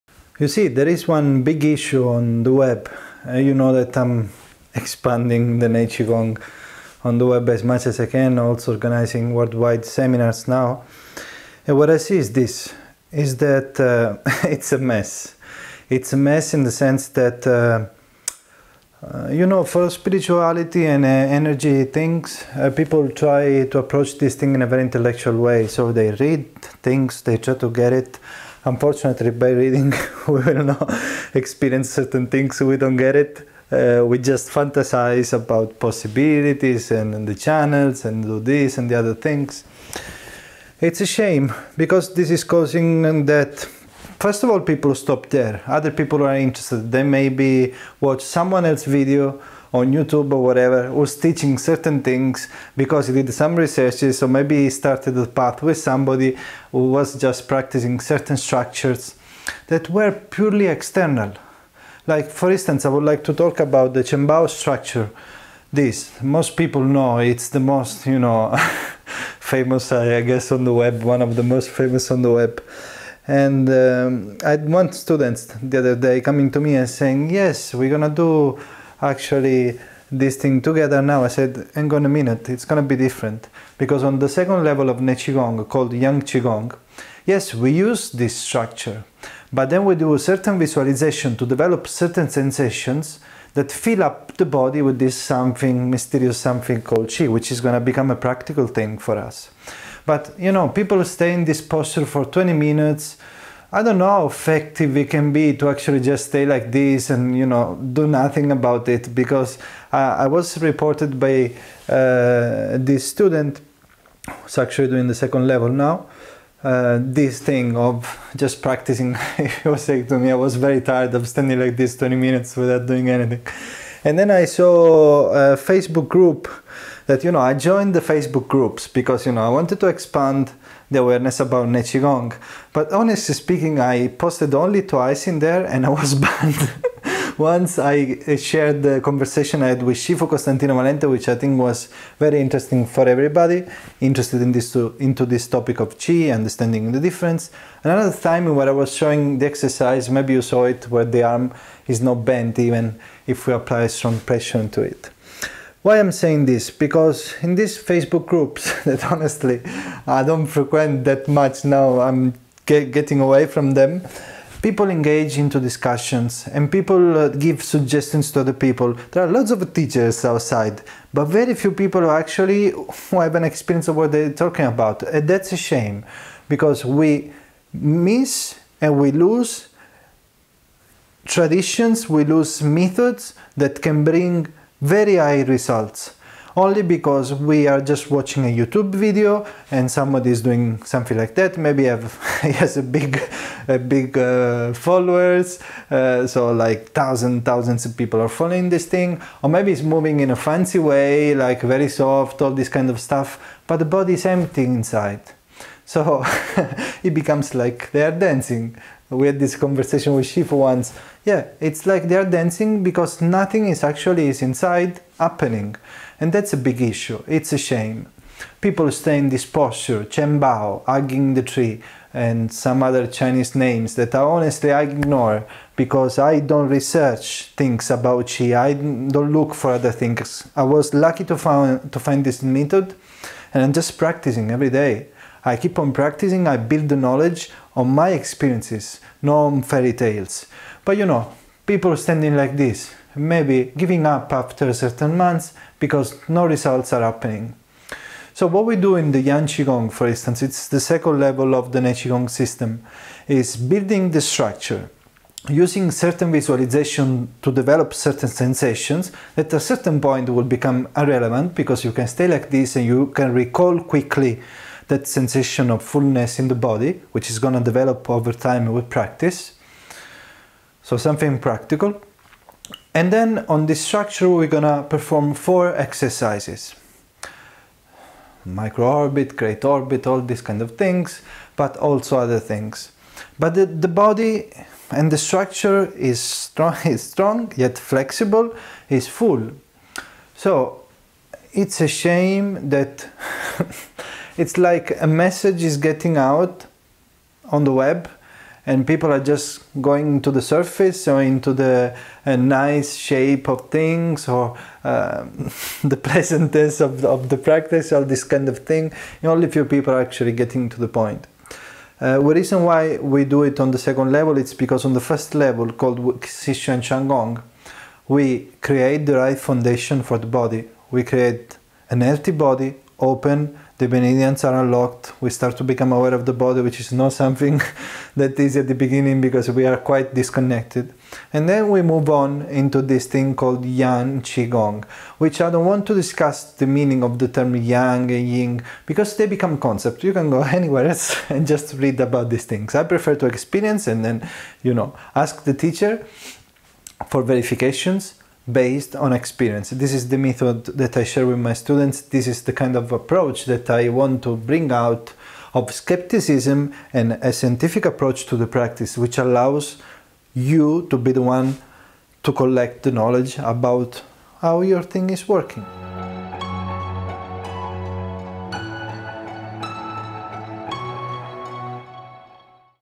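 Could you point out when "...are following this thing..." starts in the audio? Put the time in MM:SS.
03:18.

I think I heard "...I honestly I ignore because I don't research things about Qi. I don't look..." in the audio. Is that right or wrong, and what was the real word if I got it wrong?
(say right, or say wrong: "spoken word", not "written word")
right.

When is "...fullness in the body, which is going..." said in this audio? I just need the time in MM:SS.
04:25.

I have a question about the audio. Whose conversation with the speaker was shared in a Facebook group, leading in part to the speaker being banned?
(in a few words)
Shifu Costantino Valente.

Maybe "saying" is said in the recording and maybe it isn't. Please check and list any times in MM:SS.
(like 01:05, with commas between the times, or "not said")
01:16, 01:59, 02:36.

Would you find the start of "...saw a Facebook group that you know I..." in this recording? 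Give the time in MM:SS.
02:04.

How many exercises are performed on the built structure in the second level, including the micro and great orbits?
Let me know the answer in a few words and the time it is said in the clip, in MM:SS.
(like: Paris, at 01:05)
4, at 04:35.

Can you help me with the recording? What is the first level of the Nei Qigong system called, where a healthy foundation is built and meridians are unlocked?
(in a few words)
Xishu.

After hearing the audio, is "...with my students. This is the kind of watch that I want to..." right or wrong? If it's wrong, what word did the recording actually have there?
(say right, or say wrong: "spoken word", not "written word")
wrong: "approach", not "watch".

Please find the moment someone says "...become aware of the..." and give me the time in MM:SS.
05:25.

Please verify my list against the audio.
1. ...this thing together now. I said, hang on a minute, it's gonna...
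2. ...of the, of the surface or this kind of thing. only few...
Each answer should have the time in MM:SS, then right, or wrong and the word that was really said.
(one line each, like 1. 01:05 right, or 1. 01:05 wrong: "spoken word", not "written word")
1. 01:20 right
2. 05:06 wrong: "practice", not "surface".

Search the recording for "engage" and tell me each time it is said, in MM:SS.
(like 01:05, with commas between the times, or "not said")
02:44.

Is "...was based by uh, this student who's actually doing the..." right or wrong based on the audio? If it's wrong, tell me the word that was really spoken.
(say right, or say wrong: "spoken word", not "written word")
wrong: "reported", not "based".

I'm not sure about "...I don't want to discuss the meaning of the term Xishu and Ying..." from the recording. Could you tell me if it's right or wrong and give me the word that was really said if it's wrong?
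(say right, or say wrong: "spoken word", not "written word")
wrong: "Yang", not "Xishu".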